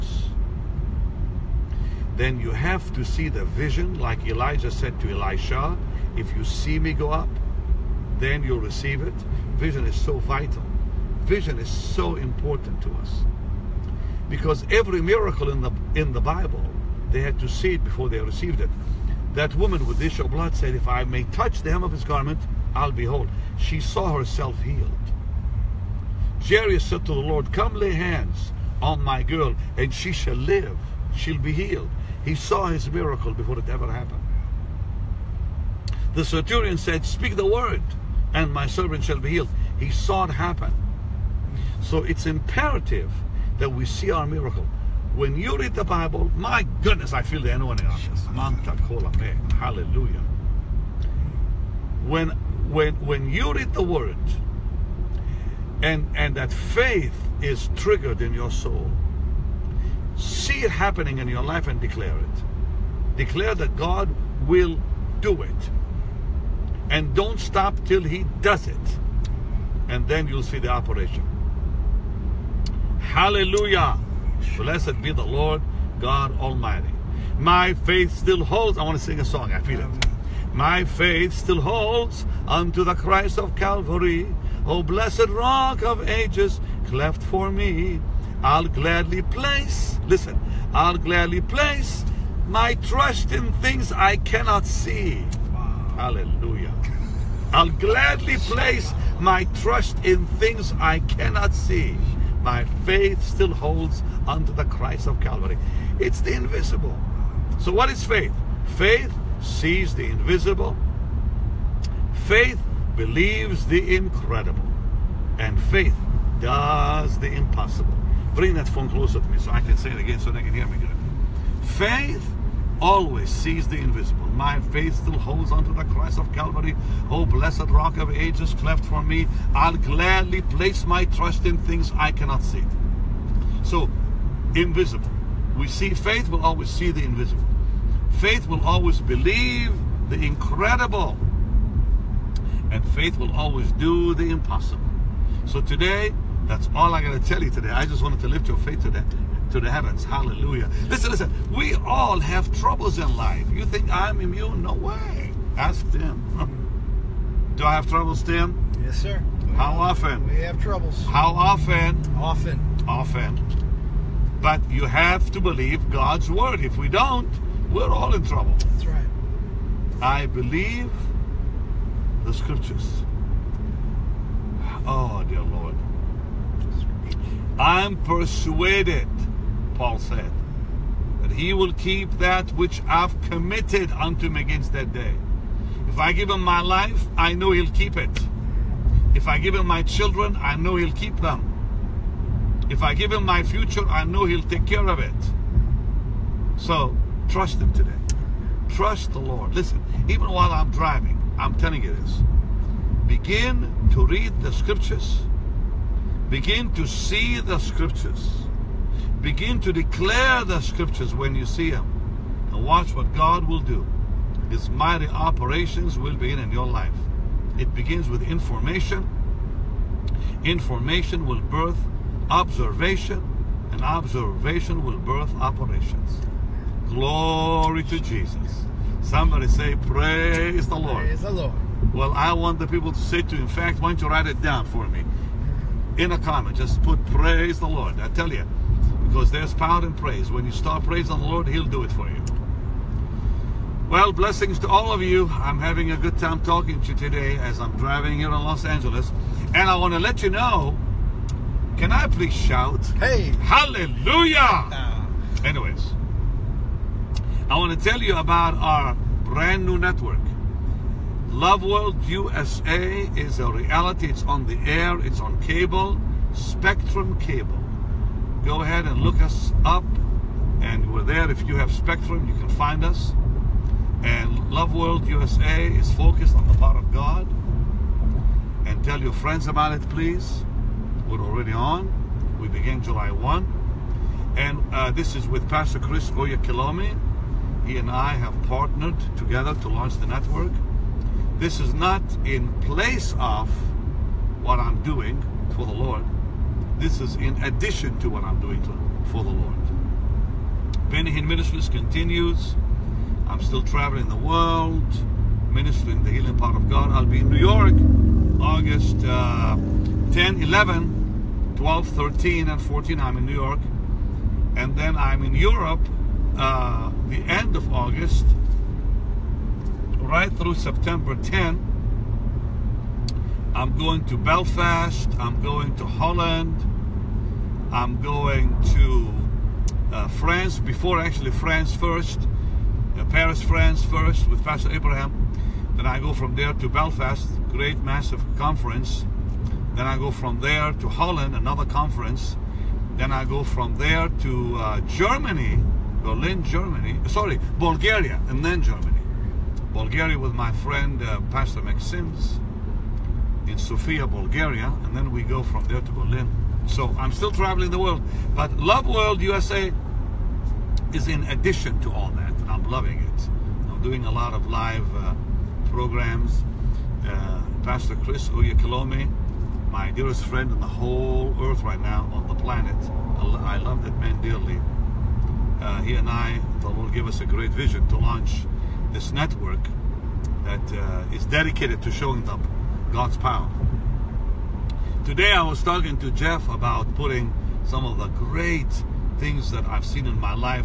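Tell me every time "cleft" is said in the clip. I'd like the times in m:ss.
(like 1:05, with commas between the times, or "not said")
1:26, 2:08.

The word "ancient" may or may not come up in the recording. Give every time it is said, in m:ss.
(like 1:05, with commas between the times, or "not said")
not said.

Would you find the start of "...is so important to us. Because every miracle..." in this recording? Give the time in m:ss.
0:11.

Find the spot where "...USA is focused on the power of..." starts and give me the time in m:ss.
4:35.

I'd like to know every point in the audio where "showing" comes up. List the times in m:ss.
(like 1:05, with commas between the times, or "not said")
6:21.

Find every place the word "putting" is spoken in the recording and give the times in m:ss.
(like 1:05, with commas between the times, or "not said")
6:26.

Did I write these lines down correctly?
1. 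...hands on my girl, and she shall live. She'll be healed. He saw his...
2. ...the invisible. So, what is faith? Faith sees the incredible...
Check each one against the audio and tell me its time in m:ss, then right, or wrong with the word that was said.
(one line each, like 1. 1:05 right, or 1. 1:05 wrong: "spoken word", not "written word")
1. 0:27 right
2. 1:46 wrong: "invisible", not "incredible".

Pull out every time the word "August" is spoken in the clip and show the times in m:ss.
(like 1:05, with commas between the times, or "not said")
5:08, 5:17.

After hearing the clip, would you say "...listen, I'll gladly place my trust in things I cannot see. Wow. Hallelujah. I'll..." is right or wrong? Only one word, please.
right.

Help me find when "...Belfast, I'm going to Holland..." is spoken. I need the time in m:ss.
5:24.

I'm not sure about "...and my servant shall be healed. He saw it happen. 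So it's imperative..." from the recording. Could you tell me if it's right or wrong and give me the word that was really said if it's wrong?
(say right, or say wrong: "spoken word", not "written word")
right.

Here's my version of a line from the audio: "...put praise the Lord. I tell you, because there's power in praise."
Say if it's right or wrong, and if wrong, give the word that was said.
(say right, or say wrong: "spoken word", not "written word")
right.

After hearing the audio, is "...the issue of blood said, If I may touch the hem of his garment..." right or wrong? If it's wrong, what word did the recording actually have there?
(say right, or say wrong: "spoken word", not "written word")
right.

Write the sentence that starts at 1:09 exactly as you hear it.
And then you'll see the operation.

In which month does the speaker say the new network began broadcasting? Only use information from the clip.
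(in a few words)
July.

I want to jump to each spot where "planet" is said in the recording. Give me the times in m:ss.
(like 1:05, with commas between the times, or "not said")
6:12.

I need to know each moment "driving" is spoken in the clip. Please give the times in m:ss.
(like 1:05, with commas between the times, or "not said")
3:20, 4:07.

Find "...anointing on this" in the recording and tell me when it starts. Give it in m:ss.
0:47.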